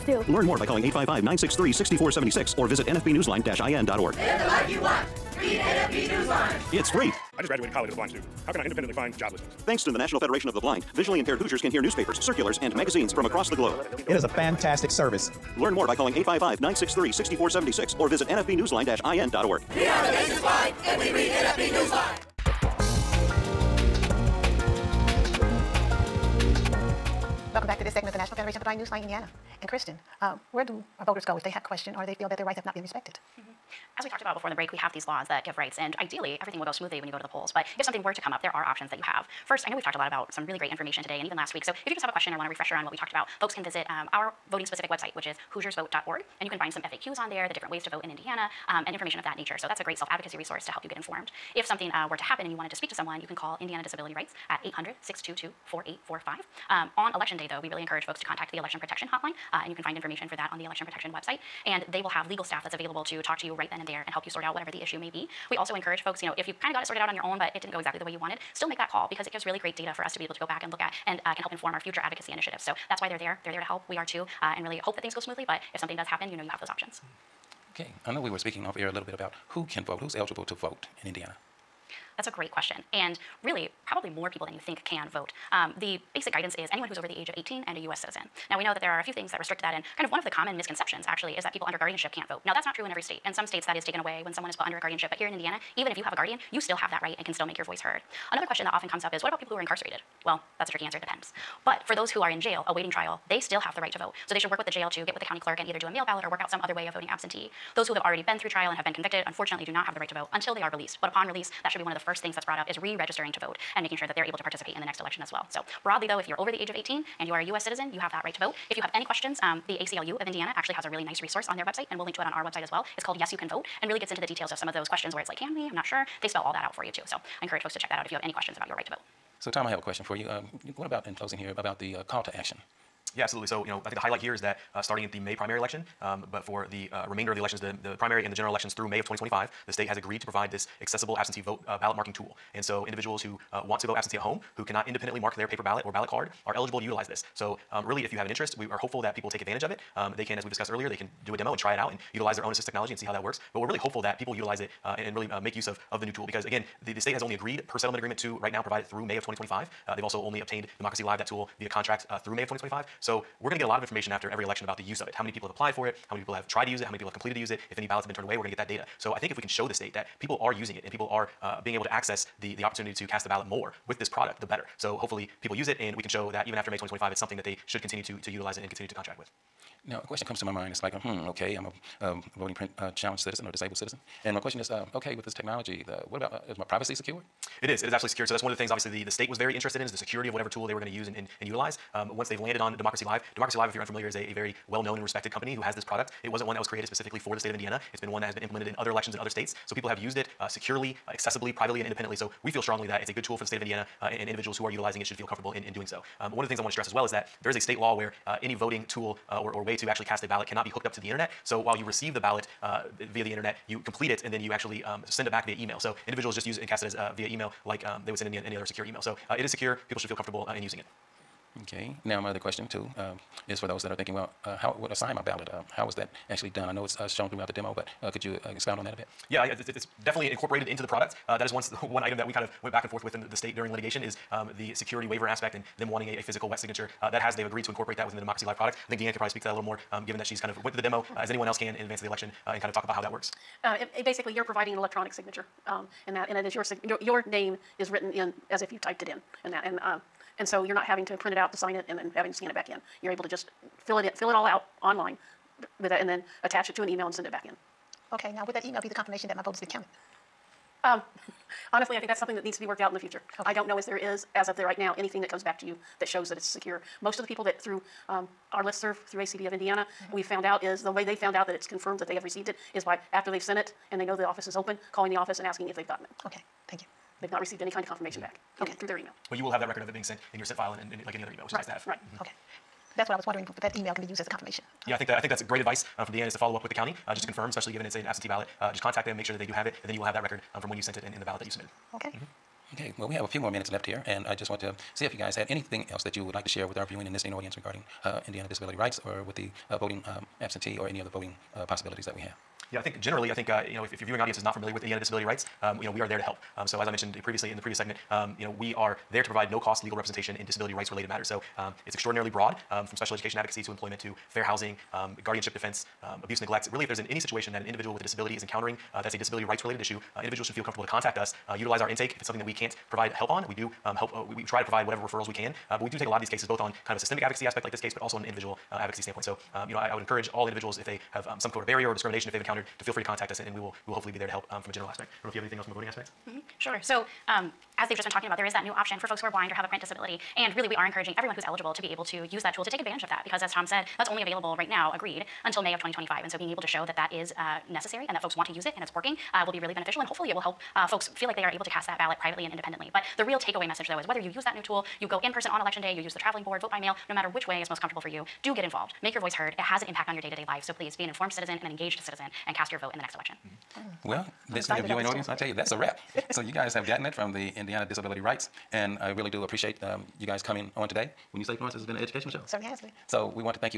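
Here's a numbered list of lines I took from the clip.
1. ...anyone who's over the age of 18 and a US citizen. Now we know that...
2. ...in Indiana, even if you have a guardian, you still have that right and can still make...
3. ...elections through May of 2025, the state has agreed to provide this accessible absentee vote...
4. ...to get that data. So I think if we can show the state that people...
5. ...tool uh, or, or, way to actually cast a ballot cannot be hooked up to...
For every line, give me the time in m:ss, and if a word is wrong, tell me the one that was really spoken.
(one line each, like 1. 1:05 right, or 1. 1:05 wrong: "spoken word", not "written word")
1. 1:26 right
2. 1:35 right
3. 2:18 right
4. 2:48 right
5. 3:28 right.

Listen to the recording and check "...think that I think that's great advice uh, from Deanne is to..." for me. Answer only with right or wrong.
right.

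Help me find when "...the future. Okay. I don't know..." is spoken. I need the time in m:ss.
4:22.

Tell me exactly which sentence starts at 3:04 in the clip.
And my question is, uh, okay, with this technology, the, what about, uh, is my privacy secured?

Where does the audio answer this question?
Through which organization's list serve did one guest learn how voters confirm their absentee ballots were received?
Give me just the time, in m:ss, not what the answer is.
4:29.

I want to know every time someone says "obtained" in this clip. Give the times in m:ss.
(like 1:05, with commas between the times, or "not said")
2:40.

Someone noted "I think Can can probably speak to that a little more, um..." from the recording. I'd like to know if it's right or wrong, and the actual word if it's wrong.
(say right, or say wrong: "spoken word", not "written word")
wrong: "Deanne", not "Can".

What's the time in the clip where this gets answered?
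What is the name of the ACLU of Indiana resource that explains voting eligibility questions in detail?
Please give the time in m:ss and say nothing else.
2:03.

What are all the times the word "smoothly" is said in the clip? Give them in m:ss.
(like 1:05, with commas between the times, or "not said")
0:36, 1:15.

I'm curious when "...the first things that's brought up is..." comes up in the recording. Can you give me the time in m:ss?
1:51.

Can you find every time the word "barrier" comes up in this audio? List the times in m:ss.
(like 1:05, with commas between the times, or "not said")
5:31.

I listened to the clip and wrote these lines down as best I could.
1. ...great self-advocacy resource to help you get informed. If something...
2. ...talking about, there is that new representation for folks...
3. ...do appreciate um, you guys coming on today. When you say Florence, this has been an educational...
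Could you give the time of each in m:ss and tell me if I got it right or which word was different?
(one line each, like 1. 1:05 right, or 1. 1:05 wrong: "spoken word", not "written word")
1. 0:49 right
2. 5:38 wrong: "option", not "representation"
3. 6:09 right.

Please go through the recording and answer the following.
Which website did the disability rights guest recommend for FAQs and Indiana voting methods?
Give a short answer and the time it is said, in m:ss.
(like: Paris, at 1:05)
hoosiersvote.org, at 0:45.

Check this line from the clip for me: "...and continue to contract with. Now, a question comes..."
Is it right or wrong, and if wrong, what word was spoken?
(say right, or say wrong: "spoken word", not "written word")
right.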